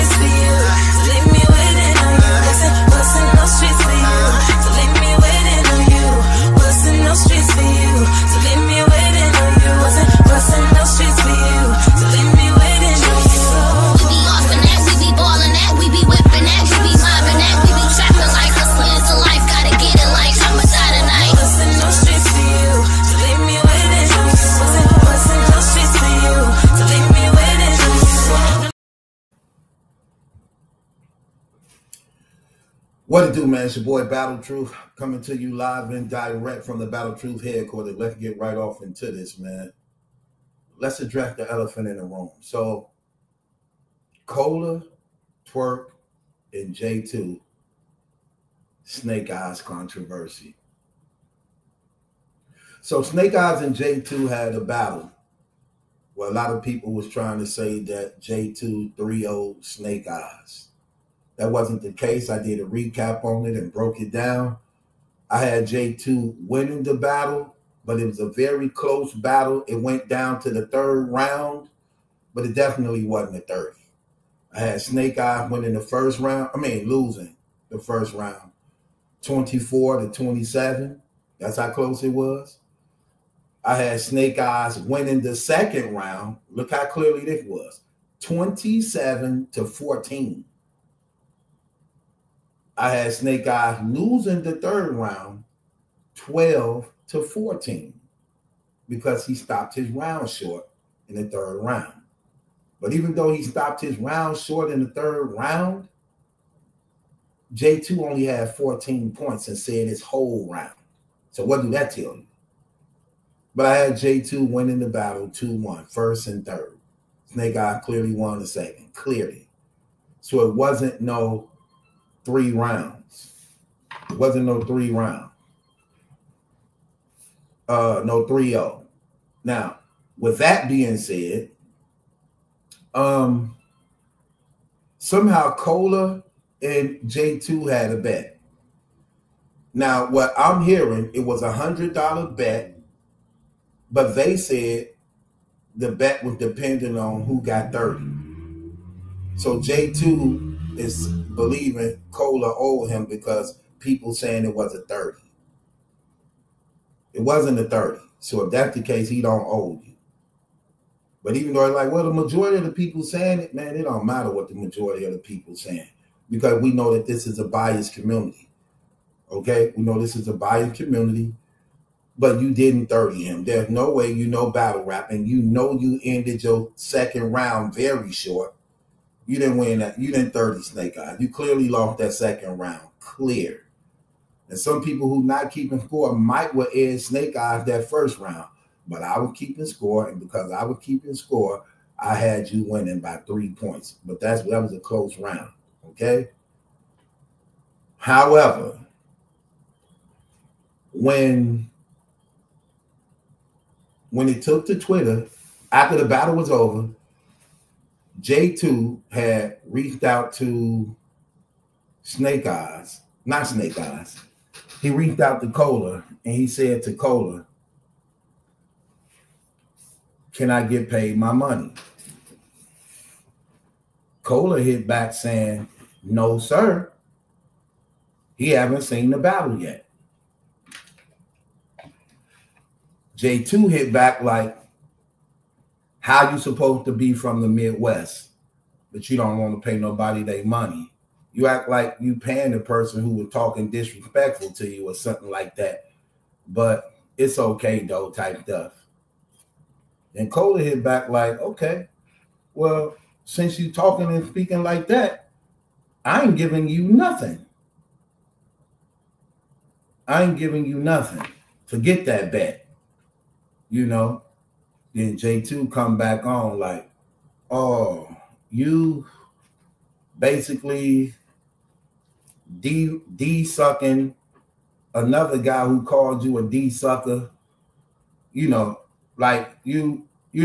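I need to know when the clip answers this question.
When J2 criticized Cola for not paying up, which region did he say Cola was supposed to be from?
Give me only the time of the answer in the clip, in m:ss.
3:57.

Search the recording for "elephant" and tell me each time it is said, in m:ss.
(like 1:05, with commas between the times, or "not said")
0:41.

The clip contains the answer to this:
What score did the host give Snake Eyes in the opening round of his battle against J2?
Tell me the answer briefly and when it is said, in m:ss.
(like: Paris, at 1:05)
24, at 1:19.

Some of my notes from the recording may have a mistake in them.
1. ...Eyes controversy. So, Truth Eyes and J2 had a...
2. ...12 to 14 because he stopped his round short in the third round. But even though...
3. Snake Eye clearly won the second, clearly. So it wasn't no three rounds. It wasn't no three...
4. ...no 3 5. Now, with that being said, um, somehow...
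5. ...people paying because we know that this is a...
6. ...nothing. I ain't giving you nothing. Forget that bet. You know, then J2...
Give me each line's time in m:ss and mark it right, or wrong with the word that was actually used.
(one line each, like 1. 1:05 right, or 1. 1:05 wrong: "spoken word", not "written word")
1. 0:49 wrong: "Snake", not "Truth"
2. 1:36 right
3. 1:57 right
4. 2:08 wrong: "0", not "5"
5. 2:45 wrong: "saying", not "paying"
6. 4:16 right.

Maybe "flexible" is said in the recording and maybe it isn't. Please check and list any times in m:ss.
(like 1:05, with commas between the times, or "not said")
not said.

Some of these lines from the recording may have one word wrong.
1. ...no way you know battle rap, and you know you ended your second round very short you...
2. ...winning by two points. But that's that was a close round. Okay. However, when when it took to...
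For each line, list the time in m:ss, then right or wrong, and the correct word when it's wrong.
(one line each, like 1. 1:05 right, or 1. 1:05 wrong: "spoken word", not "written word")
1. 2:53 right
2. 3:12 wrong: "three", not "two".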